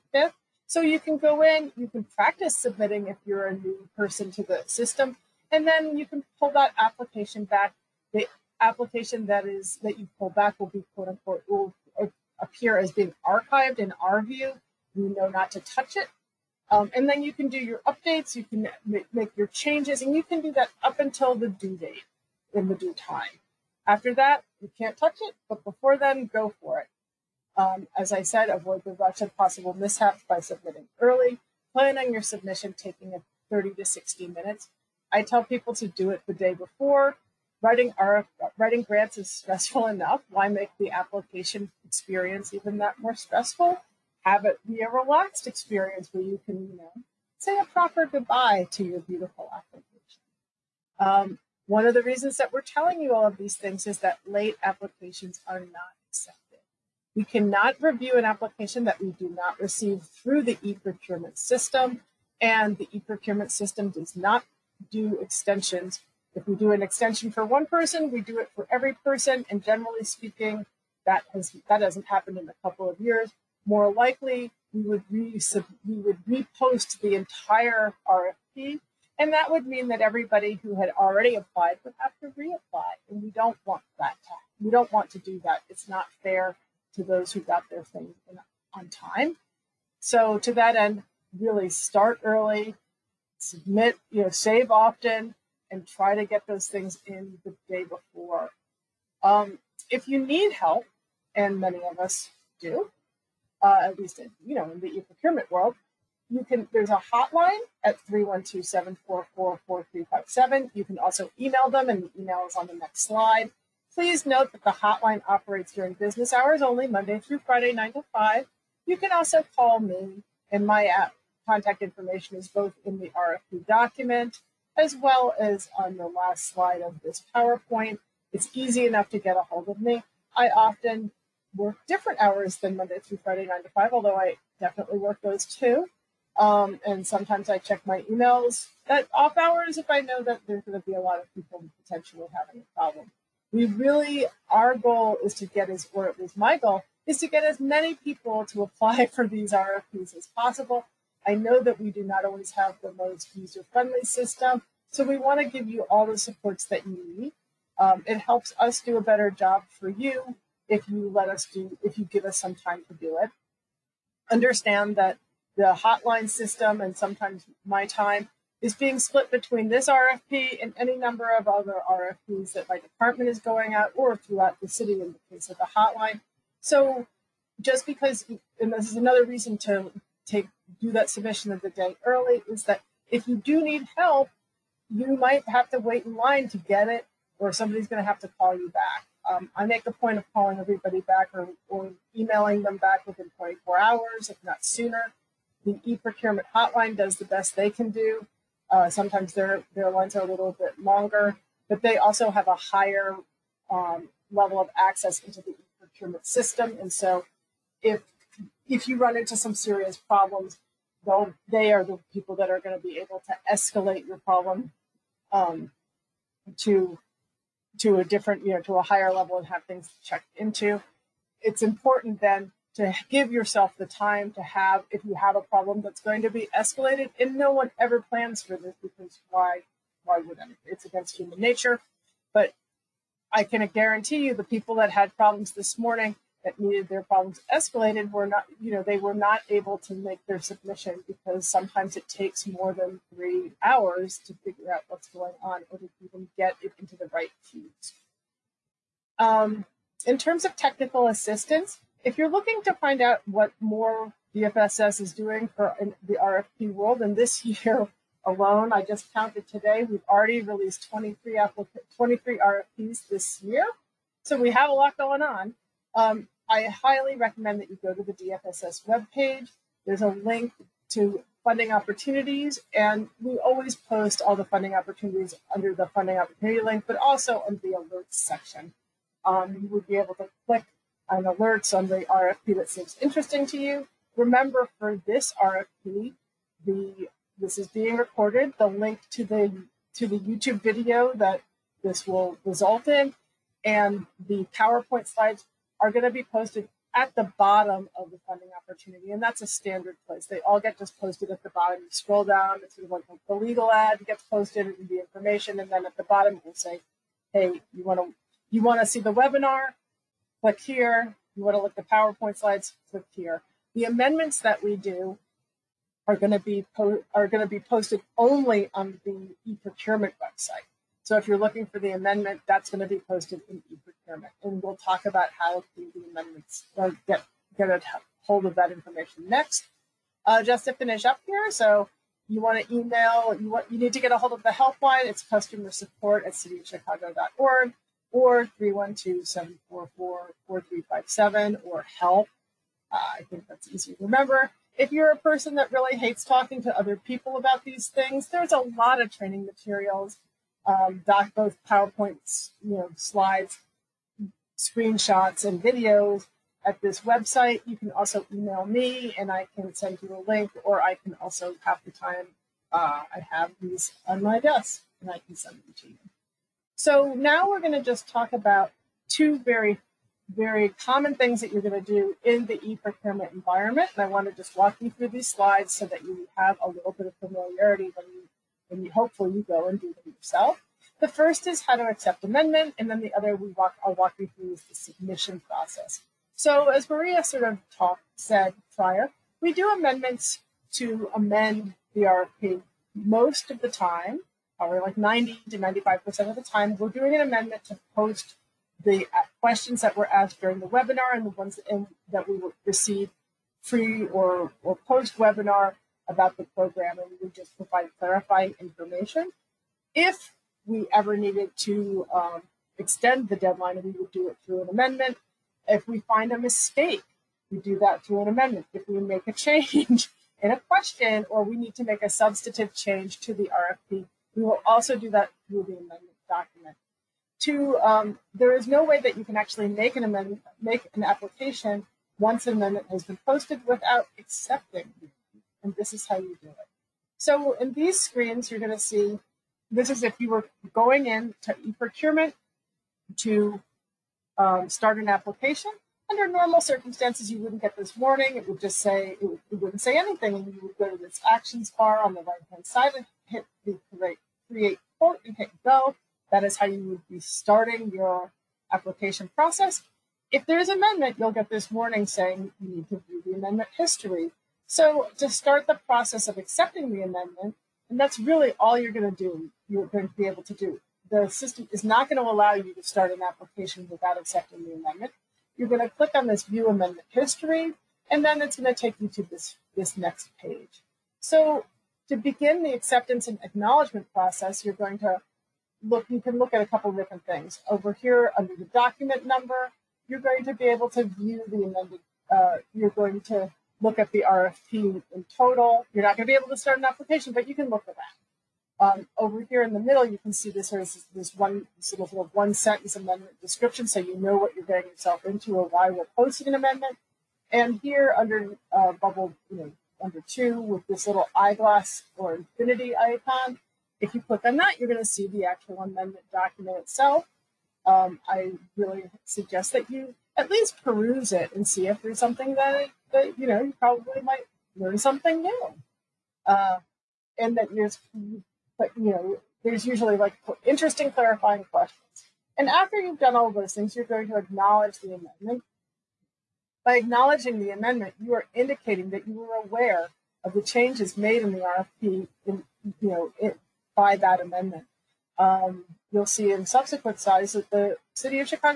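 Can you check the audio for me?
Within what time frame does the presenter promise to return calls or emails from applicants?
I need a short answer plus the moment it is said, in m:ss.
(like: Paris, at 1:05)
24 hours, at 3:13.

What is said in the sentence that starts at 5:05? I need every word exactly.
And then at the bottom, it will say, hey, you want to you want to see the webinar?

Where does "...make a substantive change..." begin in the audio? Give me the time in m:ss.
7:01.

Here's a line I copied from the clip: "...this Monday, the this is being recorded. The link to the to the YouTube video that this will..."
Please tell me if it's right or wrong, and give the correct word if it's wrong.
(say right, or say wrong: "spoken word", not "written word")
wrong: "RFP", not "Monday".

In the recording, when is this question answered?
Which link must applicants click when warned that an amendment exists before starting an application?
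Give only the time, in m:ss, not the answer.
7:56.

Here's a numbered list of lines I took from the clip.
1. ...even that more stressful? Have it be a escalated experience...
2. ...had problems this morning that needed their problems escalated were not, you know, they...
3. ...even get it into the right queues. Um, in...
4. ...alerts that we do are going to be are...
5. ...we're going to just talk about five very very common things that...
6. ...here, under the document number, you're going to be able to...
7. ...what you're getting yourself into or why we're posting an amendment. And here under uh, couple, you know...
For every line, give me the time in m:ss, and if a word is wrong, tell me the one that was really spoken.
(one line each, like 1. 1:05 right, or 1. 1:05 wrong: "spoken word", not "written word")
1. 0:42 wrong: "relaxed", not "escalated"
2. 3:54 right
3. 4:06 right
4. 5:13 wrong: "amendments", not "alerts"
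5. 6:07 wrong: "two", not "five"
6. 8:07 right
7. 8:24 wrong: "bubble", not "couple".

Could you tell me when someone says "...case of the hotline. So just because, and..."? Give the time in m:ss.
2:55.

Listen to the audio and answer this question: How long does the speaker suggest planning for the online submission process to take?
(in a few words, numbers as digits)
30 to 60 minutes.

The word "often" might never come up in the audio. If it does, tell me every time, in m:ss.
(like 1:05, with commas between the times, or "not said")
1:34, 2:10.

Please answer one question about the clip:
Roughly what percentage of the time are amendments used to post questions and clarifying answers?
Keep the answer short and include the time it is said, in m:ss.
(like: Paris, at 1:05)
90 to 95%, at 6:34.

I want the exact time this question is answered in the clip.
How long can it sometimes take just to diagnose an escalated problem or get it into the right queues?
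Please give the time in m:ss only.
4:02.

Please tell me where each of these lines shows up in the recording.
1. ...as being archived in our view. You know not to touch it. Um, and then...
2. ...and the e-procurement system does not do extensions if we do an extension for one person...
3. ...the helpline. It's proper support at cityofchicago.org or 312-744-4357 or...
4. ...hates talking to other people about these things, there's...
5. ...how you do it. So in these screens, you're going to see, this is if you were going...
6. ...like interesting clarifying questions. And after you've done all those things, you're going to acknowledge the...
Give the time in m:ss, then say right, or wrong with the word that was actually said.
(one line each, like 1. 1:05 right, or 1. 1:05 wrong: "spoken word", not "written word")
1. 0:12 right
2. 1:02 right
3. 5:34 wrong: "customer", not "proper"
4. 5:45 right
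5. 7:16 right
6. 8:50 right.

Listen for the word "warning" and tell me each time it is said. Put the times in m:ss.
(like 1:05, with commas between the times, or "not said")
7:27, 7:41.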